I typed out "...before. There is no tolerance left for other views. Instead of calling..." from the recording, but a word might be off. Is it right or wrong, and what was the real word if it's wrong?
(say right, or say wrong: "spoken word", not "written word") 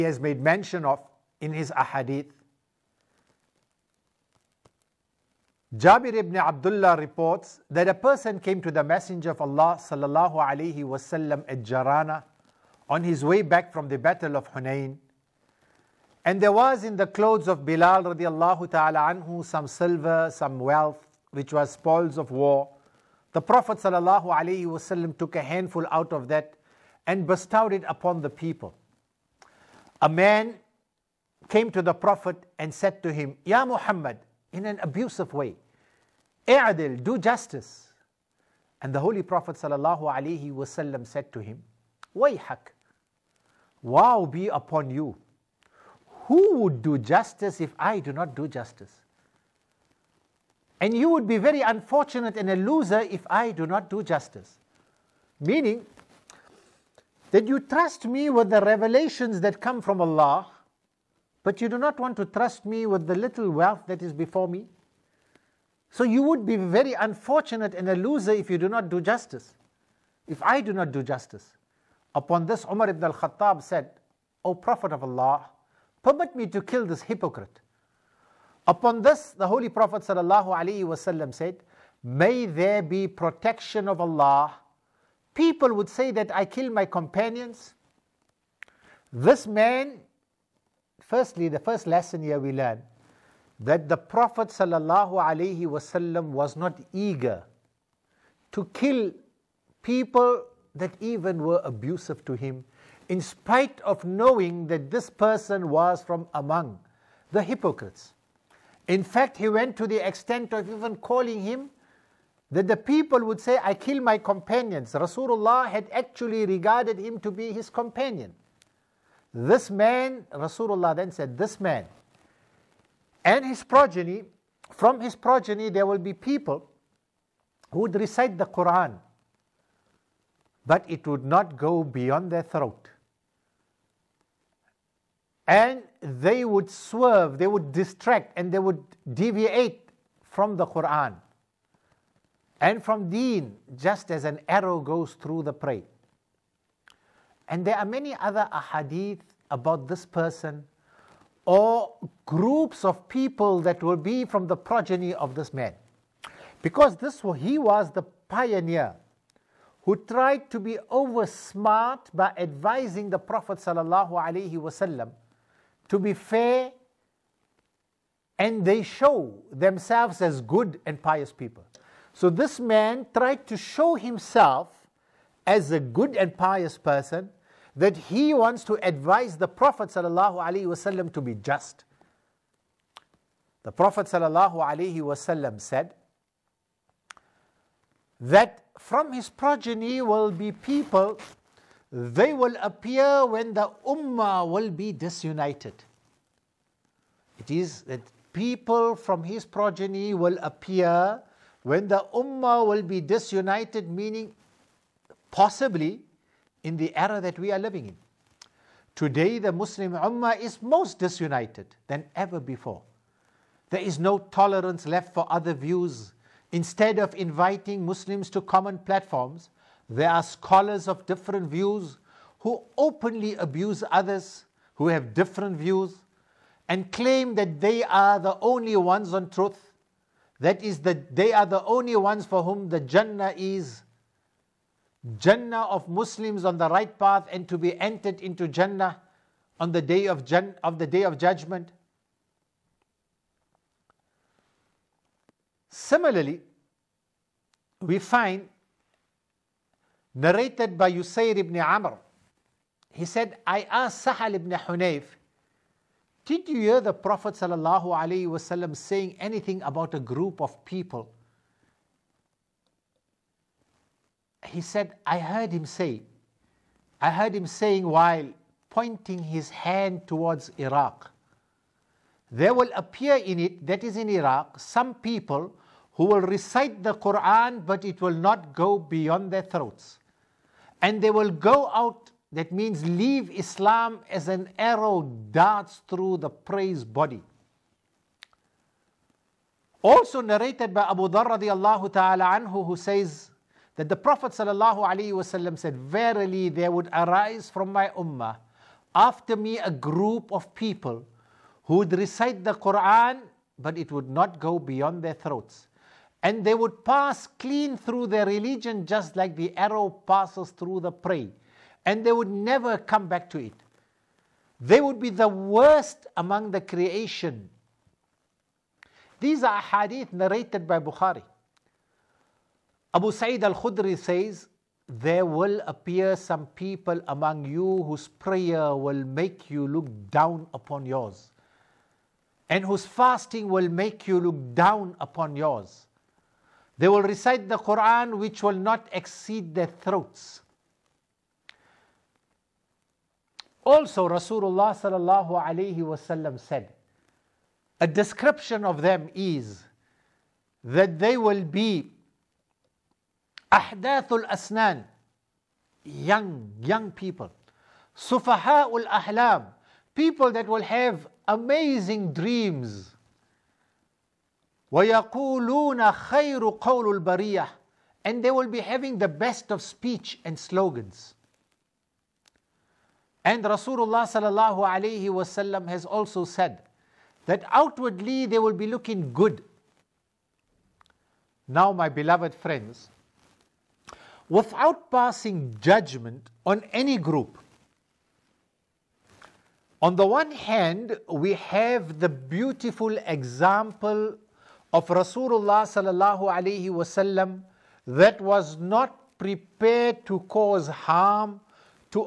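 wrong: "inviting", not "calling".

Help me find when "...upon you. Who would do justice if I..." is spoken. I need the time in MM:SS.
00:44.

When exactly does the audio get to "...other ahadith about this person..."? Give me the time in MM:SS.
02:28.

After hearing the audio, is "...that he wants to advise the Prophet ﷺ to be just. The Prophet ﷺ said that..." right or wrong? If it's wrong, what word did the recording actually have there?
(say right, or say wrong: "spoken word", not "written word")
right.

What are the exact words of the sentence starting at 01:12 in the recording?
Upon this, Umar ibn al Khattab said, O Prophet of Allah, permit me to kill this hypocrite.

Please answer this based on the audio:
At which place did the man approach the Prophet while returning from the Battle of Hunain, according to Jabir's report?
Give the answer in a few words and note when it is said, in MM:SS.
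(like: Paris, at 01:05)
Jarana, at 00:11.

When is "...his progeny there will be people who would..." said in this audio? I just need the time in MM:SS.
02:04.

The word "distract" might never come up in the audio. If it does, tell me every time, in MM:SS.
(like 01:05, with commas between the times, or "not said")
02:17.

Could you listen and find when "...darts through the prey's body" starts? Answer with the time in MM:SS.
04:45.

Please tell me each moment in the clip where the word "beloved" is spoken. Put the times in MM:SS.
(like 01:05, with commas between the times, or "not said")
06:21.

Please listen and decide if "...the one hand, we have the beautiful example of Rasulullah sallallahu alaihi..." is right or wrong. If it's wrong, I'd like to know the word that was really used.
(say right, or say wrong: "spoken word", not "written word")
right.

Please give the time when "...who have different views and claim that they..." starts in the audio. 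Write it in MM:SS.
03:44.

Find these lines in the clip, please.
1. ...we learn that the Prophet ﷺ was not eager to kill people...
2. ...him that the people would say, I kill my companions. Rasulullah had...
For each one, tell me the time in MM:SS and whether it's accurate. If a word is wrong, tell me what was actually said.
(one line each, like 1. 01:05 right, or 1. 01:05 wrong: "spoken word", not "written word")
1. 01:32 right
2. 01:51 right.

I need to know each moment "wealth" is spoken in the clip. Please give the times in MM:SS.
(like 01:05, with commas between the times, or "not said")
00:20, 01:03.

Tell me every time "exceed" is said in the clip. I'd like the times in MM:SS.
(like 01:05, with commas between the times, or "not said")
05:38.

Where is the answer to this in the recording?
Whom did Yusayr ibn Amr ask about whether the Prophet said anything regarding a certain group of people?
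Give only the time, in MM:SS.
04:14.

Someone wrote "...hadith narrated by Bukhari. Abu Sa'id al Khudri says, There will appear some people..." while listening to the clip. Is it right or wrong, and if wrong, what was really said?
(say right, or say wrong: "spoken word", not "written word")
right.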